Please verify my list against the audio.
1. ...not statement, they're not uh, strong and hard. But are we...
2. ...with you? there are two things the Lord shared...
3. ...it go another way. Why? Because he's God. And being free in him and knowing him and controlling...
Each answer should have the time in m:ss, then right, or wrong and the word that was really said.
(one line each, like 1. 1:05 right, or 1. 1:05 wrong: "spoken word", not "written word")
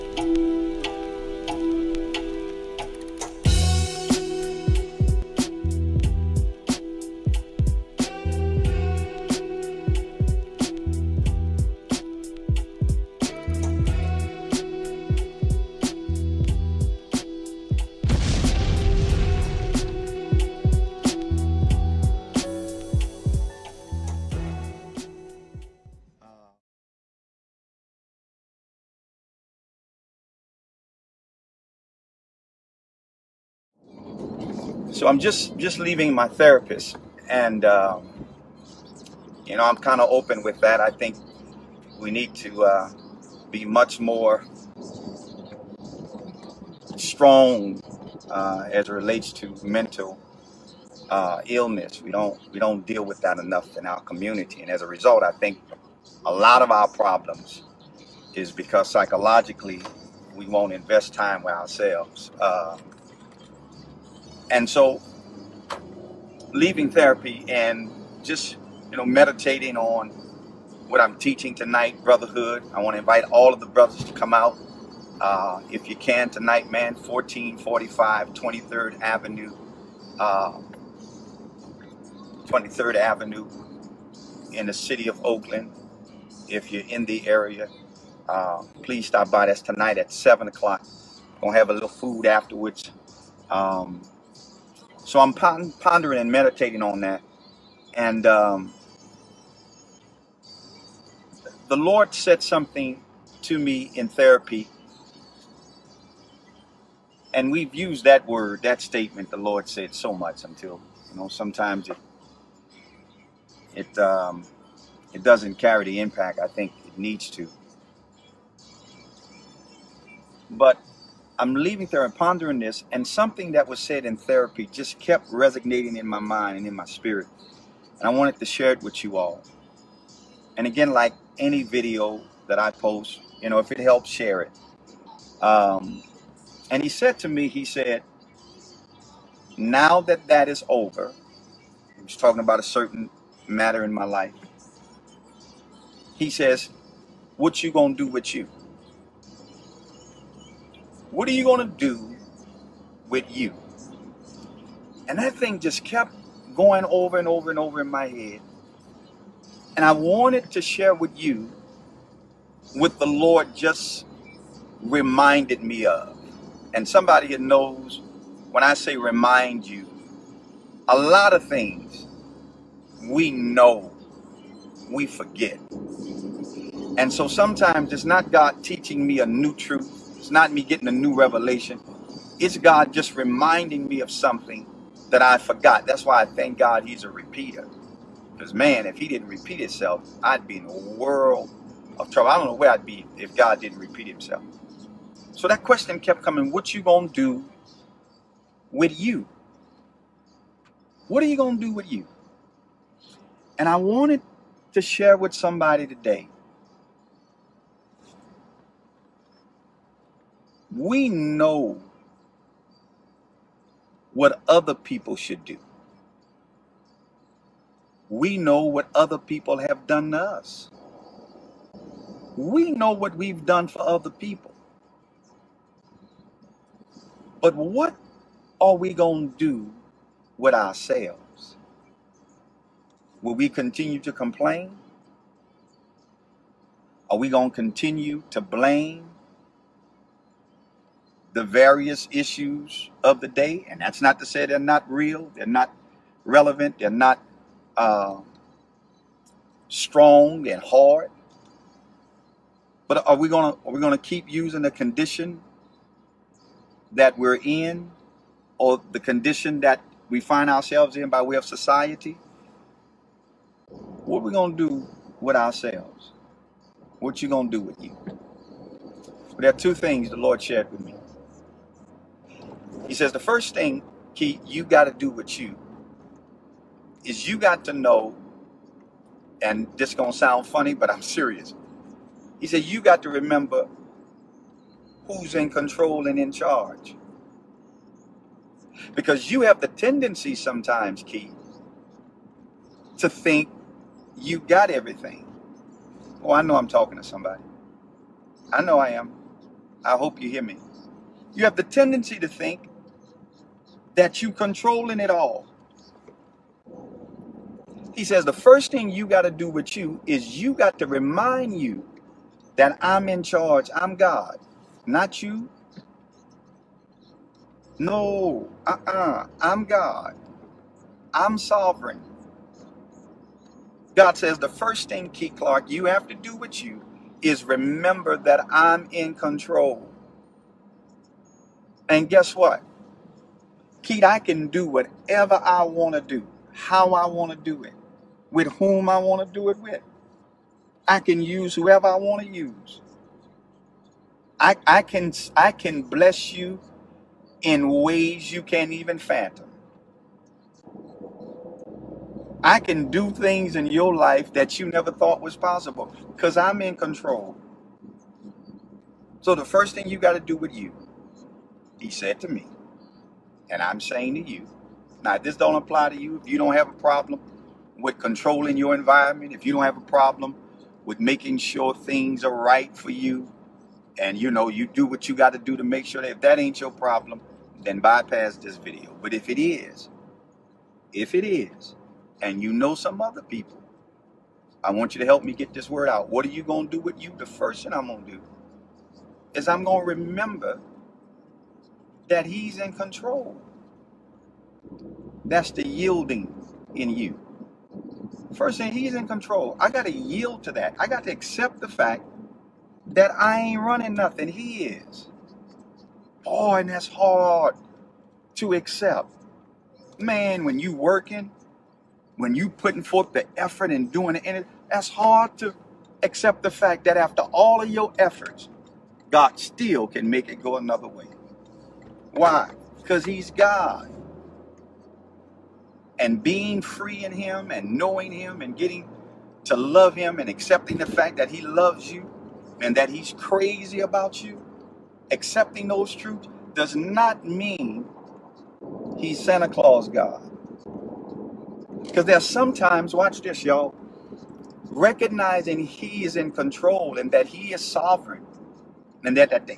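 1. 4:05 wrong: "relevant", not "statement"
2. 4:27 right
3. 7:00 wrong: "getting", not "controlling".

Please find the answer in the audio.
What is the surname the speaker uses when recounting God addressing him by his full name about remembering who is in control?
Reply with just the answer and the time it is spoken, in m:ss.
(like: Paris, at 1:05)
Clark, at 5:25.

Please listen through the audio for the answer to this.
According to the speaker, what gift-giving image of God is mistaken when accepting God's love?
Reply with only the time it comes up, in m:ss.
7:19.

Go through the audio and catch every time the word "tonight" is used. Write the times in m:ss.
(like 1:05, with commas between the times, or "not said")
1:11, 1:16, 1:29.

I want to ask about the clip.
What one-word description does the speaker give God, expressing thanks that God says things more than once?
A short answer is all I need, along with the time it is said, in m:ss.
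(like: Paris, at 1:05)
Repeater, at 3:07.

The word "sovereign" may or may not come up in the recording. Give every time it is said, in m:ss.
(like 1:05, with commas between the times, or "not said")
5:21, 7:27.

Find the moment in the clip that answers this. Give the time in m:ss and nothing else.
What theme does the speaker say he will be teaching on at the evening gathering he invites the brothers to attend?
1:12.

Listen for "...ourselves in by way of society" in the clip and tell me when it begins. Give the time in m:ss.
4:20.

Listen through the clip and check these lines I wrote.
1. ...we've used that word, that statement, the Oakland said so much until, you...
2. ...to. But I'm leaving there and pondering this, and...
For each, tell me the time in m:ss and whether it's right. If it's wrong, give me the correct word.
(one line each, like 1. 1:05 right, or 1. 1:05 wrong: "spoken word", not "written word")
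1. 1:47 wrong: "Lord", not "Oakland"
2. 1:57 right.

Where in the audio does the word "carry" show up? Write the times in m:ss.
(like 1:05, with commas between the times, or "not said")
1:55.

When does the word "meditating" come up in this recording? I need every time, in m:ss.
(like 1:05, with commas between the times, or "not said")
1:09, 1:36.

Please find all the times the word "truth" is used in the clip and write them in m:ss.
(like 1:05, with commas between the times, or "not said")
2:59, 7:15.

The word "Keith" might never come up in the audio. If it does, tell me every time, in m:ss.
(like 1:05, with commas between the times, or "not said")
4:34, 4:51, 5:25, 5:33.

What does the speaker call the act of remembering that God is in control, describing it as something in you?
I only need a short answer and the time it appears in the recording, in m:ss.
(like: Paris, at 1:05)
The yielding, at 6:35.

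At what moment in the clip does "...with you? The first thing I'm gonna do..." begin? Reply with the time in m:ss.
6:26.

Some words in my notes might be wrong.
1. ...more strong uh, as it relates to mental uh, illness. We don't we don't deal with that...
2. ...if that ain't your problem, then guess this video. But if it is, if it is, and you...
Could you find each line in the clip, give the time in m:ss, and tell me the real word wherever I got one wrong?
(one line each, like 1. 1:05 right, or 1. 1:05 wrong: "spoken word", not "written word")
1. 0:44 right
2. 6:16 wrong: "bypass", not "guess".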